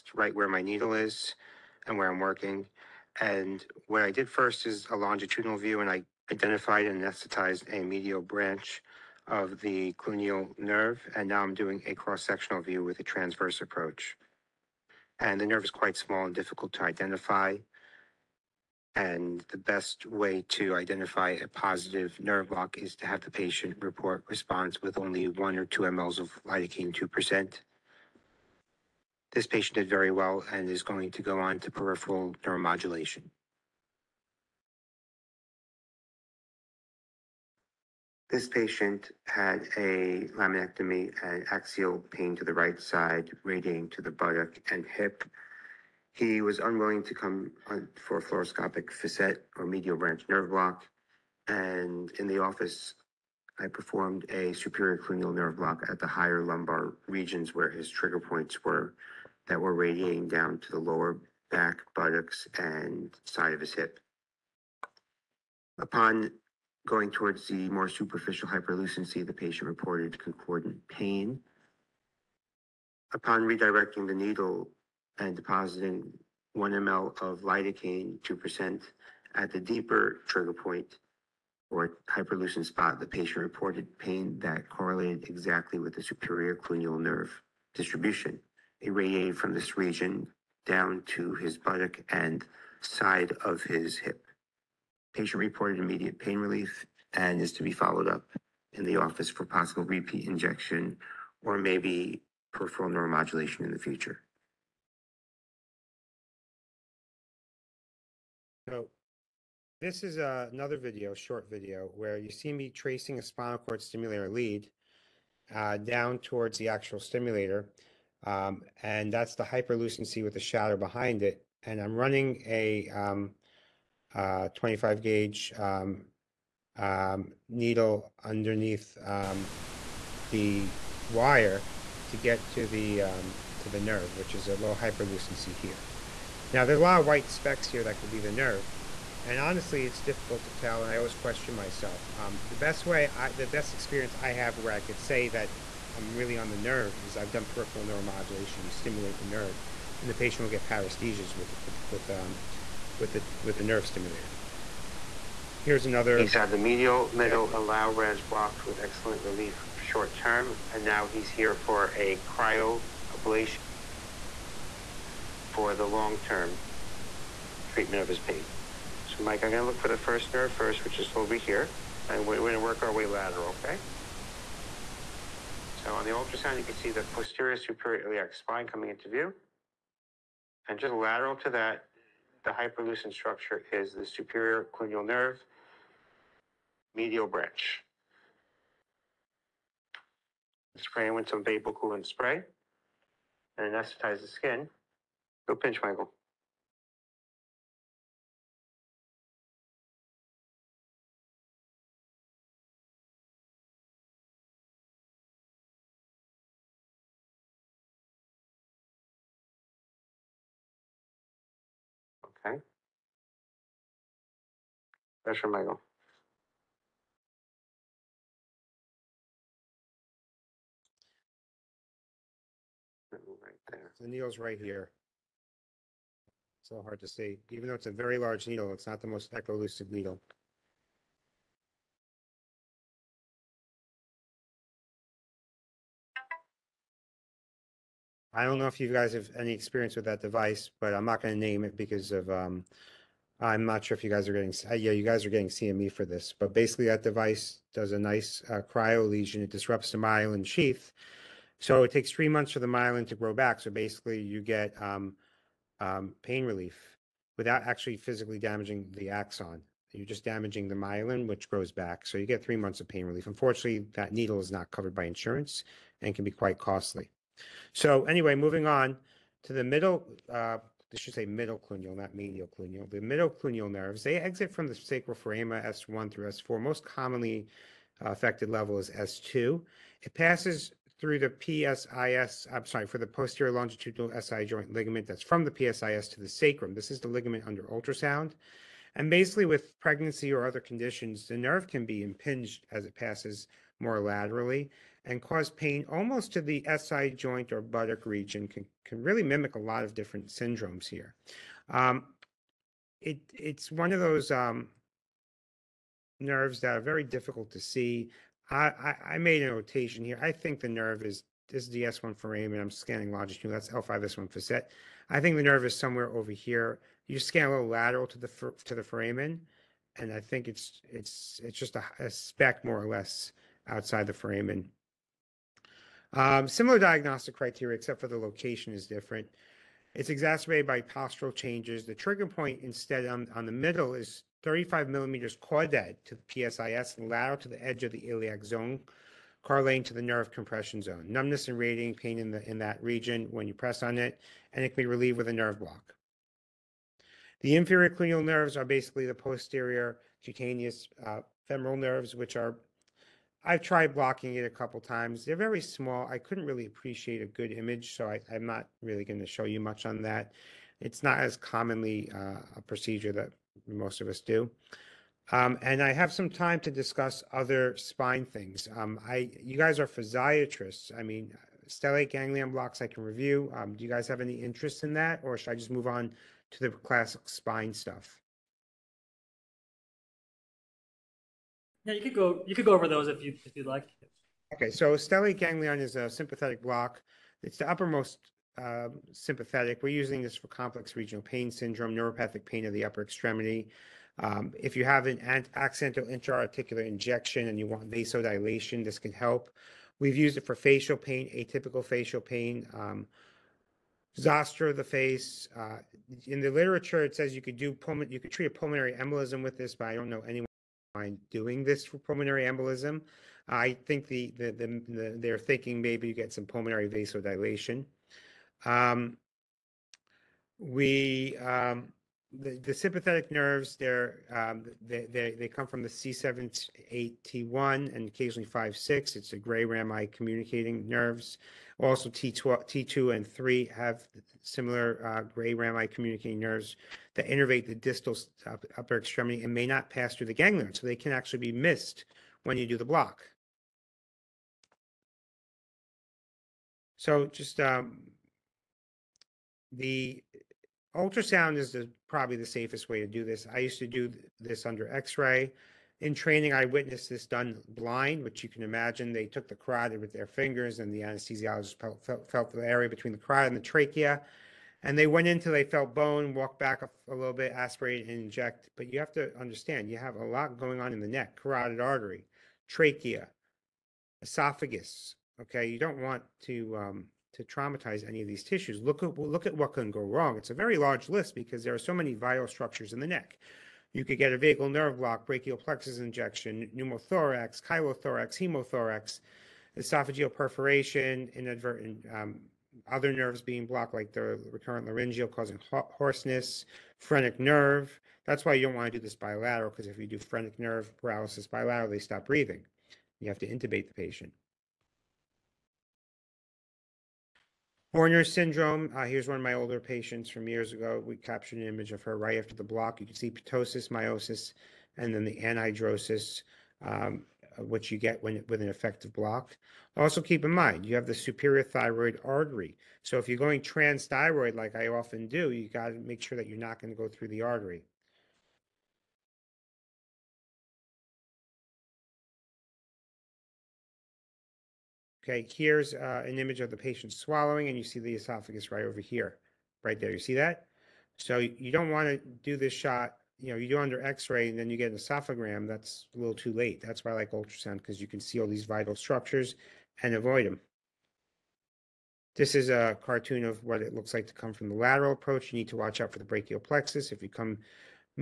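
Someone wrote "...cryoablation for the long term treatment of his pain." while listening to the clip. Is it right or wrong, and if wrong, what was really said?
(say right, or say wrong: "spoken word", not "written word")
right.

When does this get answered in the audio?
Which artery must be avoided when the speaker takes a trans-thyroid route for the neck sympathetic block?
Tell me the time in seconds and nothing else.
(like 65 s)
521 s.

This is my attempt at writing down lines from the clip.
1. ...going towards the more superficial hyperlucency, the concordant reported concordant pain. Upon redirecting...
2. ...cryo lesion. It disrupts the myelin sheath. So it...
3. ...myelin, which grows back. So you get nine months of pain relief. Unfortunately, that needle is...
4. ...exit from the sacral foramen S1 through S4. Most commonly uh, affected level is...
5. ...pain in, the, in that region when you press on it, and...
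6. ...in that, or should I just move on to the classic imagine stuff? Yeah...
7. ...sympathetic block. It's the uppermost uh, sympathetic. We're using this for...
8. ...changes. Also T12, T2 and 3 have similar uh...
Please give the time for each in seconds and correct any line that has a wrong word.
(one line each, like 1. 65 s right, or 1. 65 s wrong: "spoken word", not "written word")
1. 66 s wrong: "patient", not "concordant"
2. 248 s right
3. 260 s wrong: "three", not "nine"
4. 274 s right
5. 341 s right
6. 374 s wrong: "spine", not "imagine"
7. 386 s right
8. 430 s wrong: "nerves", not "changes".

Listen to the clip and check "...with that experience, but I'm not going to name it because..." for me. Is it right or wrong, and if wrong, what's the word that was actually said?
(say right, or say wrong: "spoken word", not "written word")
wrong: "device", not "experience".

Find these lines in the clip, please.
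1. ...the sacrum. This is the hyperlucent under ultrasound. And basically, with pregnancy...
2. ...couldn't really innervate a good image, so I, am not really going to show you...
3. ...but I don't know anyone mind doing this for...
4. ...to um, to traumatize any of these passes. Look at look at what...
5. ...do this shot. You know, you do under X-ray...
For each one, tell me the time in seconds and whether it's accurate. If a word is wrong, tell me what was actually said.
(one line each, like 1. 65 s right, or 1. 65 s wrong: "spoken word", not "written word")
1. 286 s wrong: "ligament", not "hyperlucent"
2. 356 s wrong: "appreciate", not "innervate"
3. 409 s right
4. 476 s wrong: "tissues", not "passes"
5. 542 s right.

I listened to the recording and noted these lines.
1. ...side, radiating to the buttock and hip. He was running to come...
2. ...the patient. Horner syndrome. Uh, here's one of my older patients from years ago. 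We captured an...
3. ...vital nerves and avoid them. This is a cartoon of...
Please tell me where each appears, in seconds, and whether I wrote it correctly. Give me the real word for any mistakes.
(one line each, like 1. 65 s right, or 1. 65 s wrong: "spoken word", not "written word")
1. 42 s wrong: "unwilling", not "running"
2. 503 s right
3. 548 s wrong: "structures", not "nerves".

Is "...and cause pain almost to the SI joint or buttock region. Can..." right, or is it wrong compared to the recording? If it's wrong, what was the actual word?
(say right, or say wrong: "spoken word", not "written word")
right.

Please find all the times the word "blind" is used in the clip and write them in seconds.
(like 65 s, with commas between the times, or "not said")
457 s.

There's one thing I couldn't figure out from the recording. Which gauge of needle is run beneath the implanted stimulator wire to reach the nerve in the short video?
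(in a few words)
25.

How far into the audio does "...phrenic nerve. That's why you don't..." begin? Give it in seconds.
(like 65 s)
496 s.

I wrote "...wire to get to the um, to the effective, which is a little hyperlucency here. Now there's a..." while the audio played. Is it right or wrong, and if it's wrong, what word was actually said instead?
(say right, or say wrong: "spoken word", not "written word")
wrong: "nerve", not "effective".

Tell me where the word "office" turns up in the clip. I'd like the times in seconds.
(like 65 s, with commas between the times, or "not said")
52 s, 98 s.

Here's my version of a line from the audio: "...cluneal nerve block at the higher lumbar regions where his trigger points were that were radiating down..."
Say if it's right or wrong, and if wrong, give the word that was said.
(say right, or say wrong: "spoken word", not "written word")
right.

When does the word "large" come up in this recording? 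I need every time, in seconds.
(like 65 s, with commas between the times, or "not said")
228 s, 480 s.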